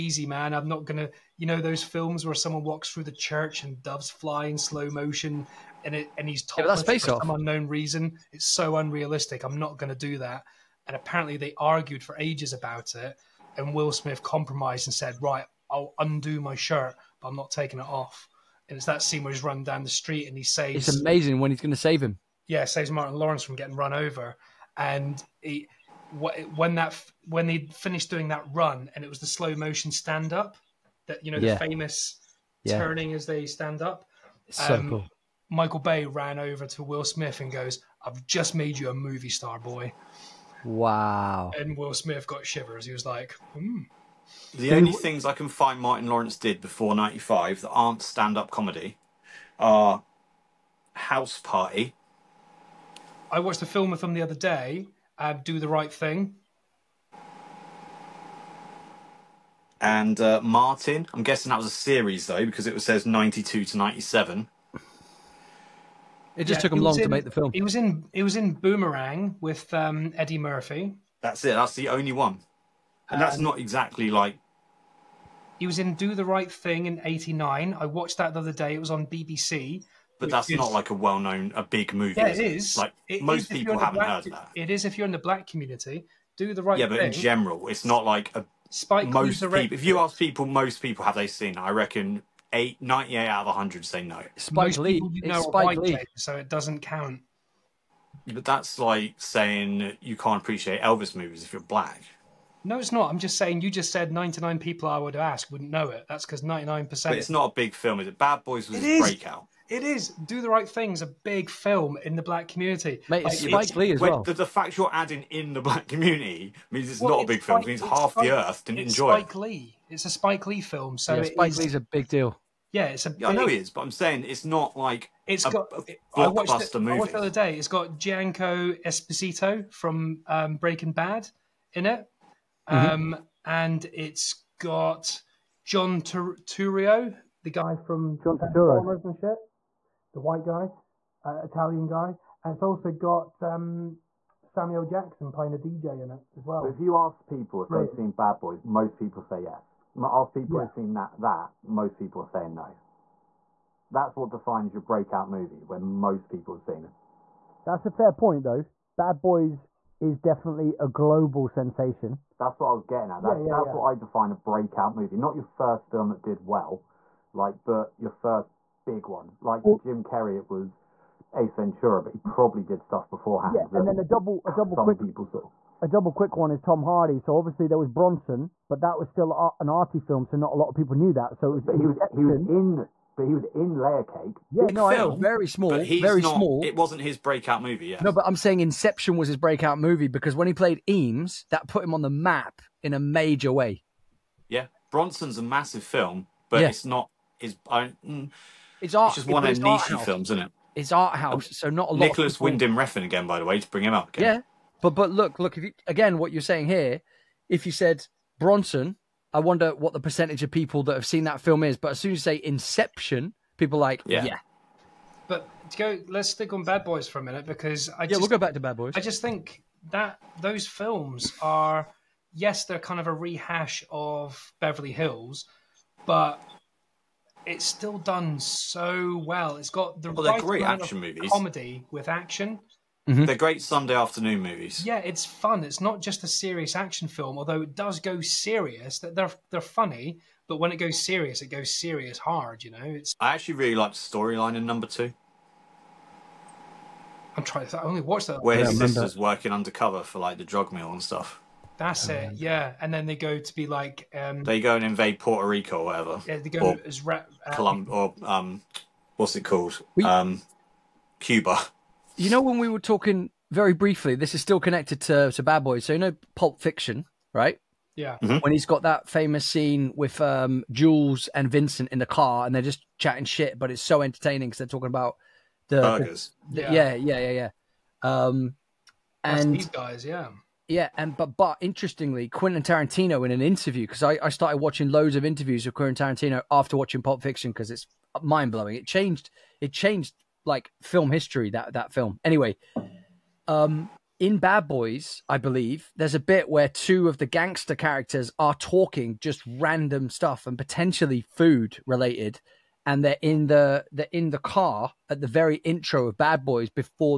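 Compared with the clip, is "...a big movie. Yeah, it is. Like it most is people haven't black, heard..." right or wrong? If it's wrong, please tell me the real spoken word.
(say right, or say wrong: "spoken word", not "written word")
right.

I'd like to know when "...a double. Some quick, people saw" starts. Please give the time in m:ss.
2:54.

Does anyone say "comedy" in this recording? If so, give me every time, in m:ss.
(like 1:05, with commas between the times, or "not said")
0:48, 3:51.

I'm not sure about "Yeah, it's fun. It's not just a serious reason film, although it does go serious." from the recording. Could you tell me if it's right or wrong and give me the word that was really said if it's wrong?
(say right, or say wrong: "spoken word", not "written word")
wrong: "action", not "reason".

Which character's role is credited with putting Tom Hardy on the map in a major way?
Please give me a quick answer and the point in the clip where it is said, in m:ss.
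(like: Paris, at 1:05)
Eames, at 3:10.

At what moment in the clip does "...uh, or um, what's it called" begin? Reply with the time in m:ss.
4:17.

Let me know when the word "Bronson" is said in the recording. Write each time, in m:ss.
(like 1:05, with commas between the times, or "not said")
2:57, 3:14, 3:28.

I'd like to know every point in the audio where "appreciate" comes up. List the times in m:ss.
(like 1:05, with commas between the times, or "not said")
1:40.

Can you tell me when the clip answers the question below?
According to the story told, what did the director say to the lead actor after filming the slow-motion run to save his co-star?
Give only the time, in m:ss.
0:38.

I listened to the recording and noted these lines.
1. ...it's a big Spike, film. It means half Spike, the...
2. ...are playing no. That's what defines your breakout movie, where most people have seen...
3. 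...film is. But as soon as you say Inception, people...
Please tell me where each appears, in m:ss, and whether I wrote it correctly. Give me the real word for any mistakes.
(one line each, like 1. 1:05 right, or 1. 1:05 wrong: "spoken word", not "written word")
1. 1:57 right
2. 2:32 wrong: "saying", not "playing"
3. 3:31 right.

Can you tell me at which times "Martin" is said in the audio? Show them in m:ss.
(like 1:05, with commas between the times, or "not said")
0:22, 0:45, 1:00.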